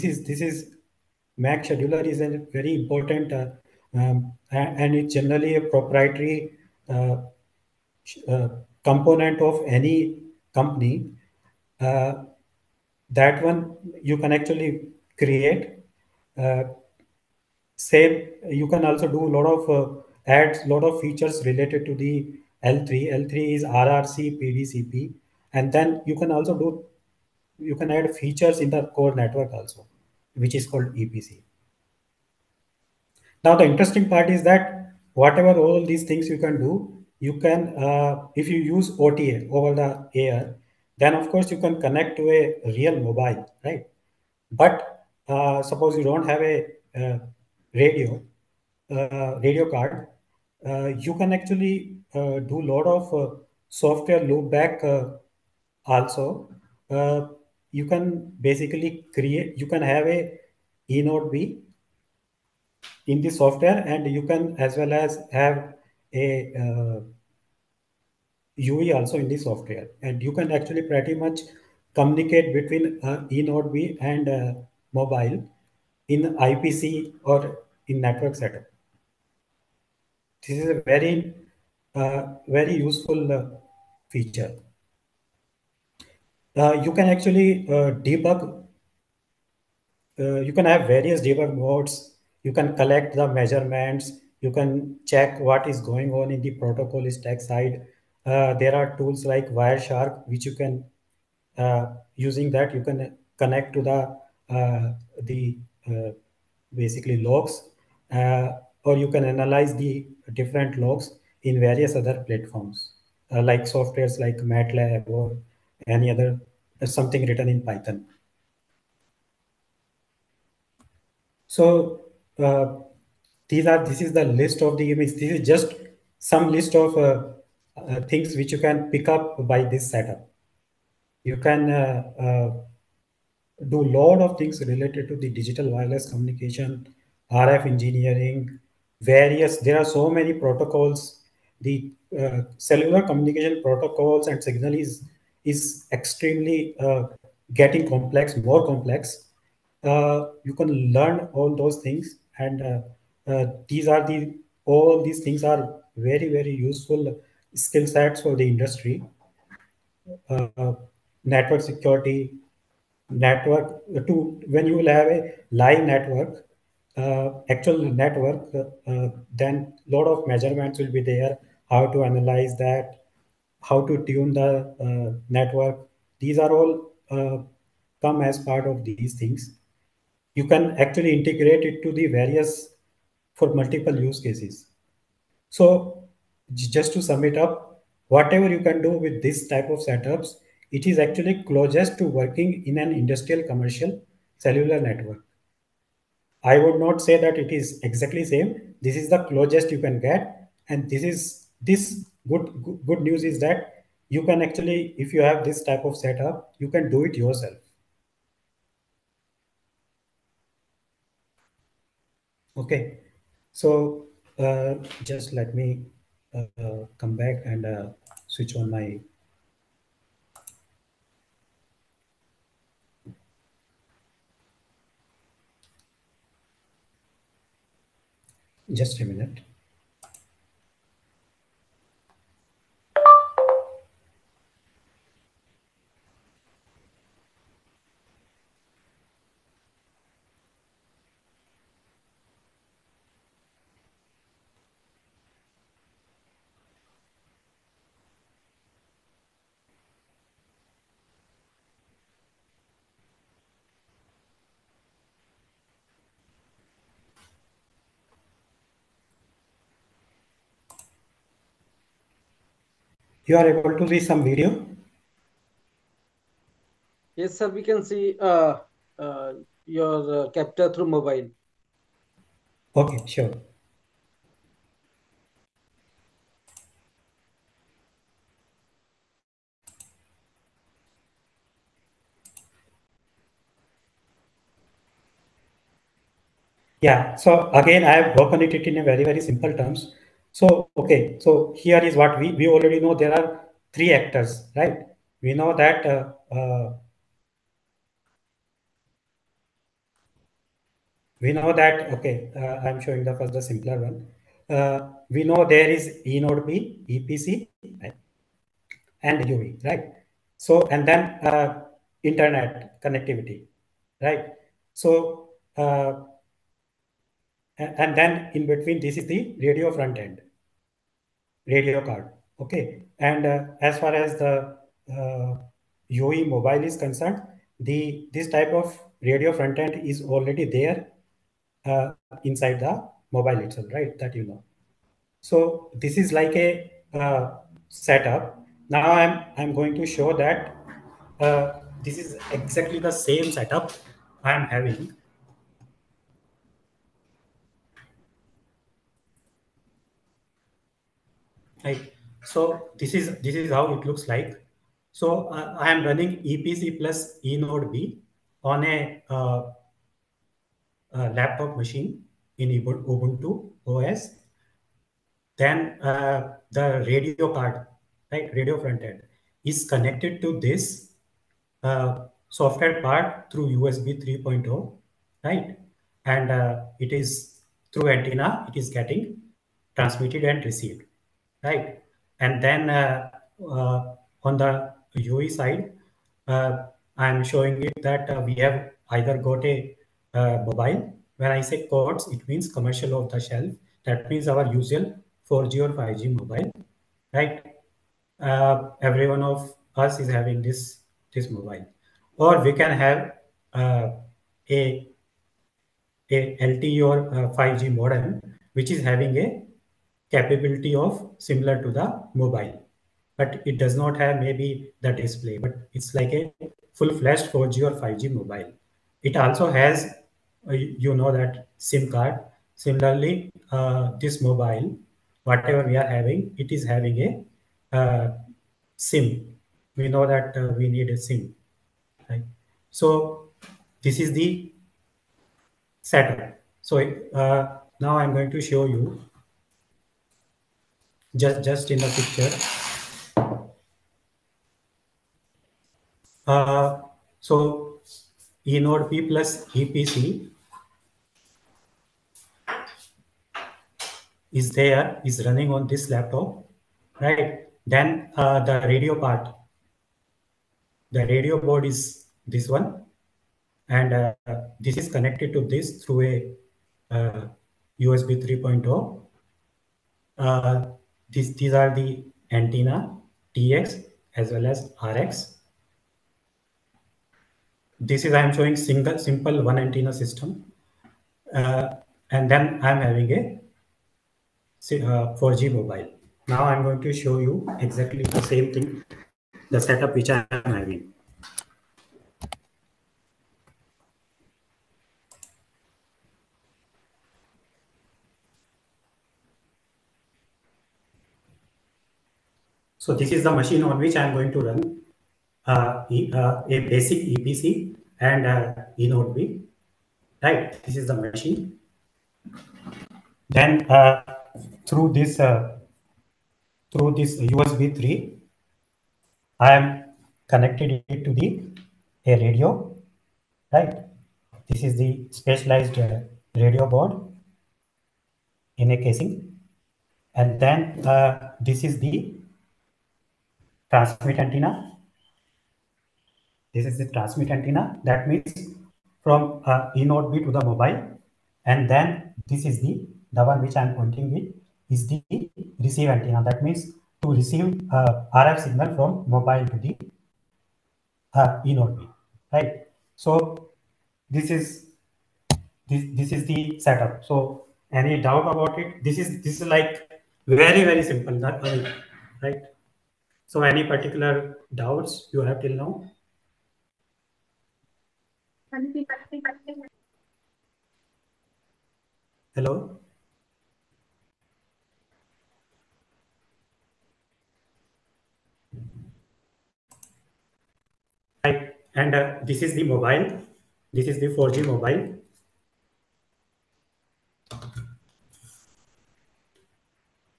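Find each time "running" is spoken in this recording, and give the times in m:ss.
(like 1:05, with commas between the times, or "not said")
5:55, 7:35.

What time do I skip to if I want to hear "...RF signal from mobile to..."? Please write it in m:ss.
9:08.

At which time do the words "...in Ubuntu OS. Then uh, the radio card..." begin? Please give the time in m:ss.
6:02.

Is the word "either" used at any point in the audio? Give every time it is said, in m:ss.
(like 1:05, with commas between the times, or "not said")
6:28.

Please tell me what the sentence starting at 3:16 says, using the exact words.
I would not say that it is exactly same.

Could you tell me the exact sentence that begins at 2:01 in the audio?
So these are this is the list of the images.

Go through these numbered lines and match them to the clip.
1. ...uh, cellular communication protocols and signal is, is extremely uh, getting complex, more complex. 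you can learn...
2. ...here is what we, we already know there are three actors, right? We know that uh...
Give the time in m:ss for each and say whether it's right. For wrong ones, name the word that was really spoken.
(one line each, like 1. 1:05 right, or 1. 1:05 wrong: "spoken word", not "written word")
1. 2:22 right
2. 4:51 right.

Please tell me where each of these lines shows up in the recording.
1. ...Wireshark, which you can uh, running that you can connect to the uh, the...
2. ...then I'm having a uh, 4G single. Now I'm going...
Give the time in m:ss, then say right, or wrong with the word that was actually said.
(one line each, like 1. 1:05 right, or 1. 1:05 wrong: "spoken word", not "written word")
1. 1:39 wrong: "using", not "running"
2. 8:02 wrong: "mobile", not "single".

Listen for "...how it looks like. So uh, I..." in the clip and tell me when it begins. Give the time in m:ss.
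5:53.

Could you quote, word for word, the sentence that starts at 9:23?
So any particular doubts you have till now?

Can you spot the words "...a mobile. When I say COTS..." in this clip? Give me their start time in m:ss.
6:29.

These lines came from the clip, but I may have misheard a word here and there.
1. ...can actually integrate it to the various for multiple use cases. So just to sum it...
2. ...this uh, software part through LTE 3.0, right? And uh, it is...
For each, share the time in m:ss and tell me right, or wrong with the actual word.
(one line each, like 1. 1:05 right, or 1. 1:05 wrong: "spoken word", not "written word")
1. 3:00 right
2. 6:10 wrong: "USB", not "LTE".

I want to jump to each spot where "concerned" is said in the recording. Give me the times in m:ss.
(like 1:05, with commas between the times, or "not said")
5:26.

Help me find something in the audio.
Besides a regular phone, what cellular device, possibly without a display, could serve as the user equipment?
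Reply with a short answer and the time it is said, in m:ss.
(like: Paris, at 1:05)
LTE or 5G modem, at 6:46.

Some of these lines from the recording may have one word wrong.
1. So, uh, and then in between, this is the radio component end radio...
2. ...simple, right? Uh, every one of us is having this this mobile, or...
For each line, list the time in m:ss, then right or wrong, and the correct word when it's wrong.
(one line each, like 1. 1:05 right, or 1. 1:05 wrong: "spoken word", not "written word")
1. 5:14 wrong: "front", not "component"
2. 6:36 wrong: "mobile", not "simple".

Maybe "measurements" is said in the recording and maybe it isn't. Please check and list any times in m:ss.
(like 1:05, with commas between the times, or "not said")
1:33, 2:50.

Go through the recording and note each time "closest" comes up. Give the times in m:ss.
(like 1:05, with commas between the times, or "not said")
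3:11, 3:19.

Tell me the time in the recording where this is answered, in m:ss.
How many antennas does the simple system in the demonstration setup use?
7:58.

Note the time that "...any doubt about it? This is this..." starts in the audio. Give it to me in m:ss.
9:17.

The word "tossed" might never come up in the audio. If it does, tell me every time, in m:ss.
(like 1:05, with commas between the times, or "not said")
not said.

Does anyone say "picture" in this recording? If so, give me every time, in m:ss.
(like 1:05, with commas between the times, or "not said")
7:21.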